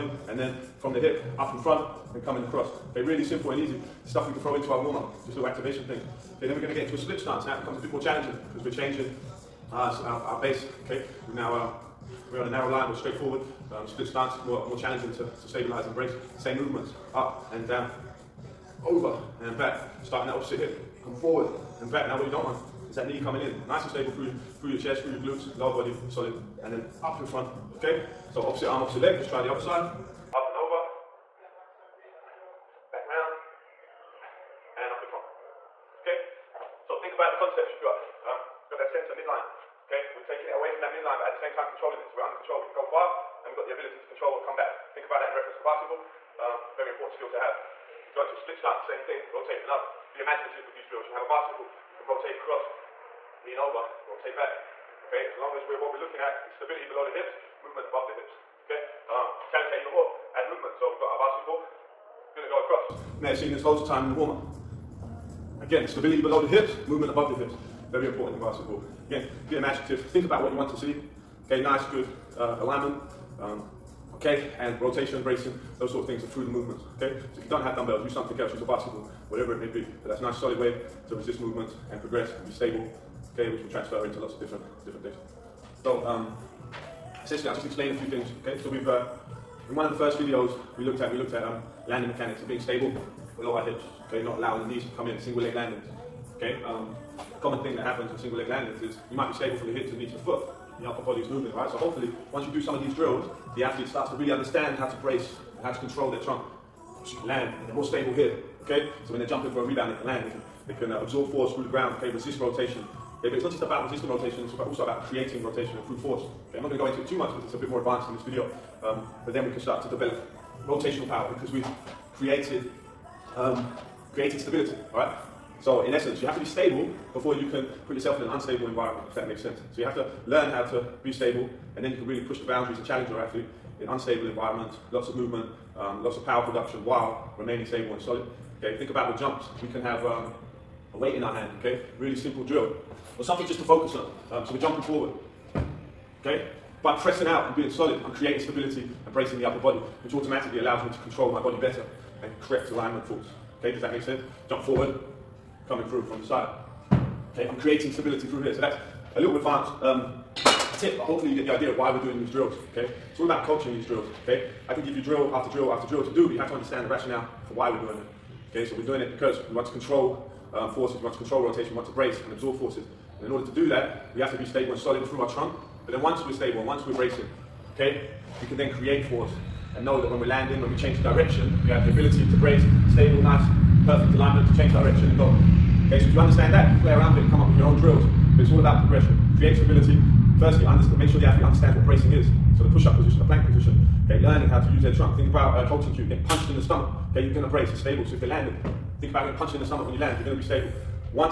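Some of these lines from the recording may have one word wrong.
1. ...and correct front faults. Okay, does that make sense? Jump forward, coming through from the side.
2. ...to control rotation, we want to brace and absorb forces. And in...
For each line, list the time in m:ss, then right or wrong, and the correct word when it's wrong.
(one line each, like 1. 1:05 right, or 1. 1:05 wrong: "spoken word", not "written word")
1. 2:32 wrong: "alignment", not "front"
2. 2:51 right.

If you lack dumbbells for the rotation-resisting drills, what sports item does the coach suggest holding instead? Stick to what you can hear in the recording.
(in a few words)
A basketball.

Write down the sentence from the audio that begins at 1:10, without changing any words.
Think about what you want to see.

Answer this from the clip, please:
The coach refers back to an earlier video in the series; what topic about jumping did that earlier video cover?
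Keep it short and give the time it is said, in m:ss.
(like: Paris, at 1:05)
Landing mechanics, at 1:31.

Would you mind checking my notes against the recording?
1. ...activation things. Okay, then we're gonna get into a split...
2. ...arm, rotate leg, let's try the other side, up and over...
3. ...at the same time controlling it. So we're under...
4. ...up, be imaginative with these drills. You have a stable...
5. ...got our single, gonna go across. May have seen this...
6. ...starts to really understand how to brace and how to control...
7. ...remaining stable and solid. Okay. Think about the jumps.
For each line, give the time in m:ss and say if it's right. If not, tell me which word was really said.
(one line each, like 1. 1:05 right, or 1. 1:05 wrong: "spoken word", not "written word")
1. 0:05 right
2. 0:28 wrong: "opposite", not "rotate"
3. 0:41 right
4. 0:49 wrong: "bicycle", not "stable"
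5. 1:00 wrong: "bicycle", not "single"
6. 1:43 right
7. 2:17 right.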